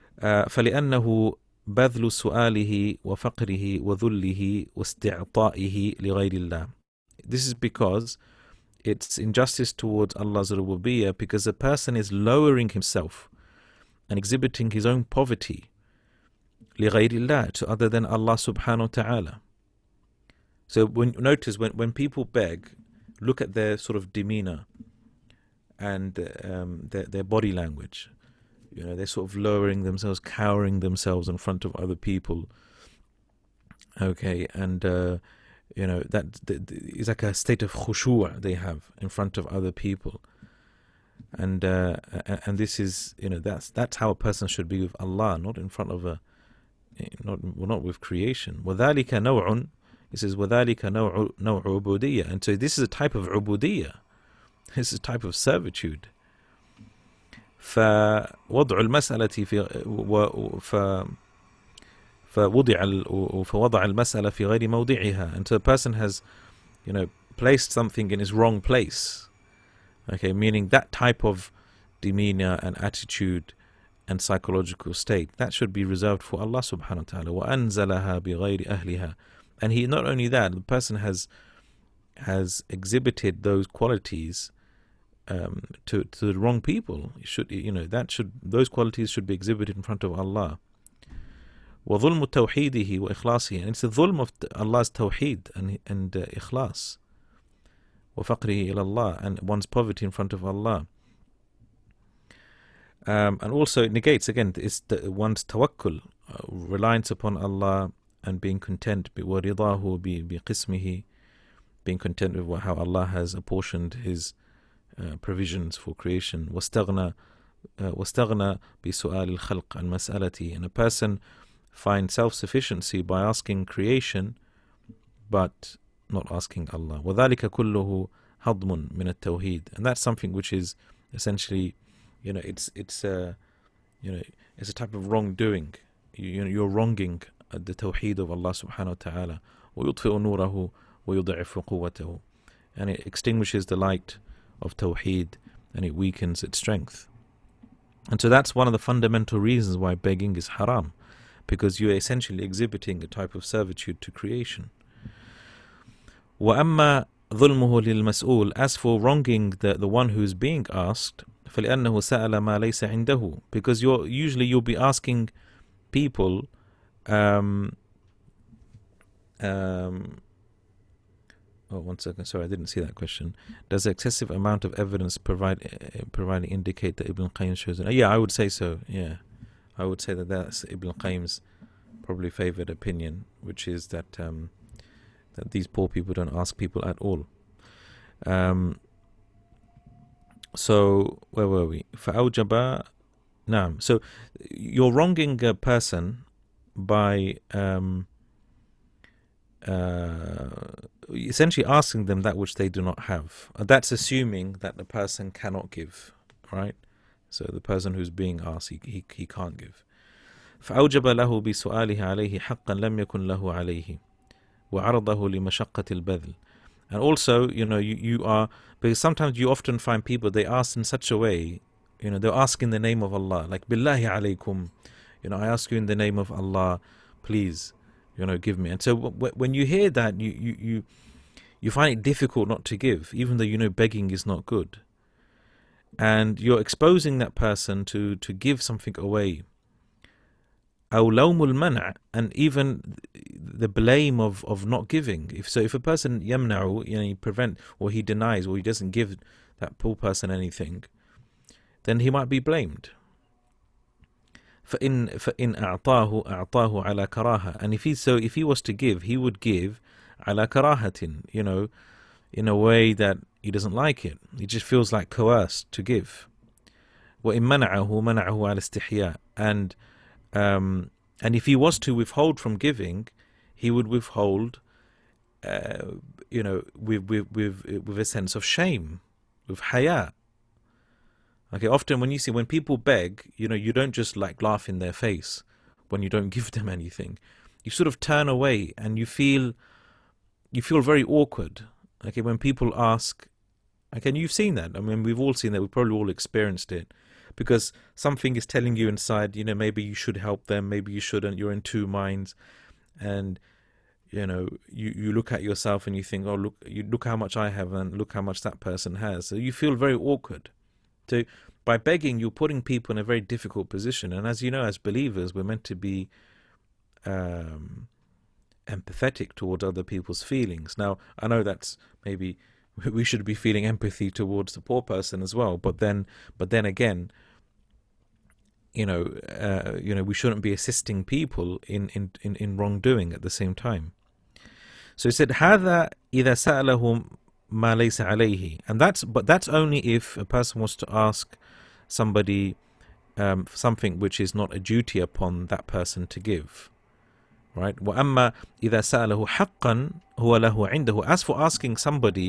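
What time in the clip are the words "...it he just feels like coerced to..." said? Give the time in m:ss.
4:24.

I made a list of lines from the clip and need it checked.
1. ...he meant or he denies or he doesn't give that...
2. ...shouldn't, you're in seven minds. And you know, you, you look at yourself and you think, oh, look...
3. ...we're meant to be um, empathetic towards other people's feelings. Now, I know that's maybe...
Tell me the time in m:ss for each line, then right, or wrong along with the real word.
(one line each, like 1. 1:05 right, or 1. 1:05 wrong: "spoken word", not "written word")
1. 4:07 wrong: "prevent", not "meant"
2. 5:00 wrong: "two", not "seven"
3. 5:15 right.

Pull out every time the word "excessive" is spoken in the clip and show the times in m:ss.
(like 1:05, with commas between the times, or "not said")
2:53.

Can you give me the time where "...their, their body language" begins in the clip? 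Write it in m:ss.
0:26.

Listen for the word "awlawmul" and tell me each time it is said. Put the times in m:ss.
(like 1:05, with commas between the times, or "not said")
4:00.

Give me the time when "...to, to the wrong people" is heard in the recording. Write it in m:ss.
1:25.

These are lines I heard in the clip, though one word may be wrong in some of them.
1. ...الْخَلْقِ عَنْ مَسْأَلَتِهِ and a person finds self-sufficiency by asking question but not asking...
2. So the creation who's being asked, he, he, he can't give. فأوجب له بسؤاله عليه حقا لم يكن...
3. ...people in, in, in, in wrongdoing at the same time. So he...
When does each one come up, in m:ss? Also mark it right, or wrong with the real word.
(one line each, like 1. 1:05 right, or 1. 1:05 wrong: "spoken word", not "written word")
1. 1:59 wrong: "creation", not "question"
2. 3:27 wrong: "person", not "creation"
3. 5:31 right.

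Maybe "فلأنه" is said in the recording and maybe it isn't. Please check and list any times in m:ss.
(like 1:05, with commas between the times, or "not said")
0:00, 2:41.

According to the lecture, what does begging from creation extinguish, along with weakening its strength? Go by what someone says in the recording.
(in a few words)
The light of Tawheed.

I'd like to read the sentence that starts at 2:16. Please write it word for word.
You, you know, you're wronging uh, the tawheed of Allah subhanahu wa taala.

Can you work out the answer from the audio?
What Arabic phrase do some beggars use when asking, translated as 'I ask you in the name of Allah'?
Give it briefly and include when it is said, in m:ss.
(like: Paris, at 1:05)
billahi alaykum, at 3:43.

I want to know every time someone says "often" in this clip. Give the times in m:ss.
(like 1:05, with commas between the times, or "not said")
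3:39, 4:41.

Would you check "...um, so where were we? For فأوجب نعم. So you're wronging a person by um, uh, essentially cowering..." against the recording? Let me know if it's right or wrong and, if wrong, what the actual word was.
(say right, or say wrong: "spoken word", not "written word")
wrong: "asking", not "cowering".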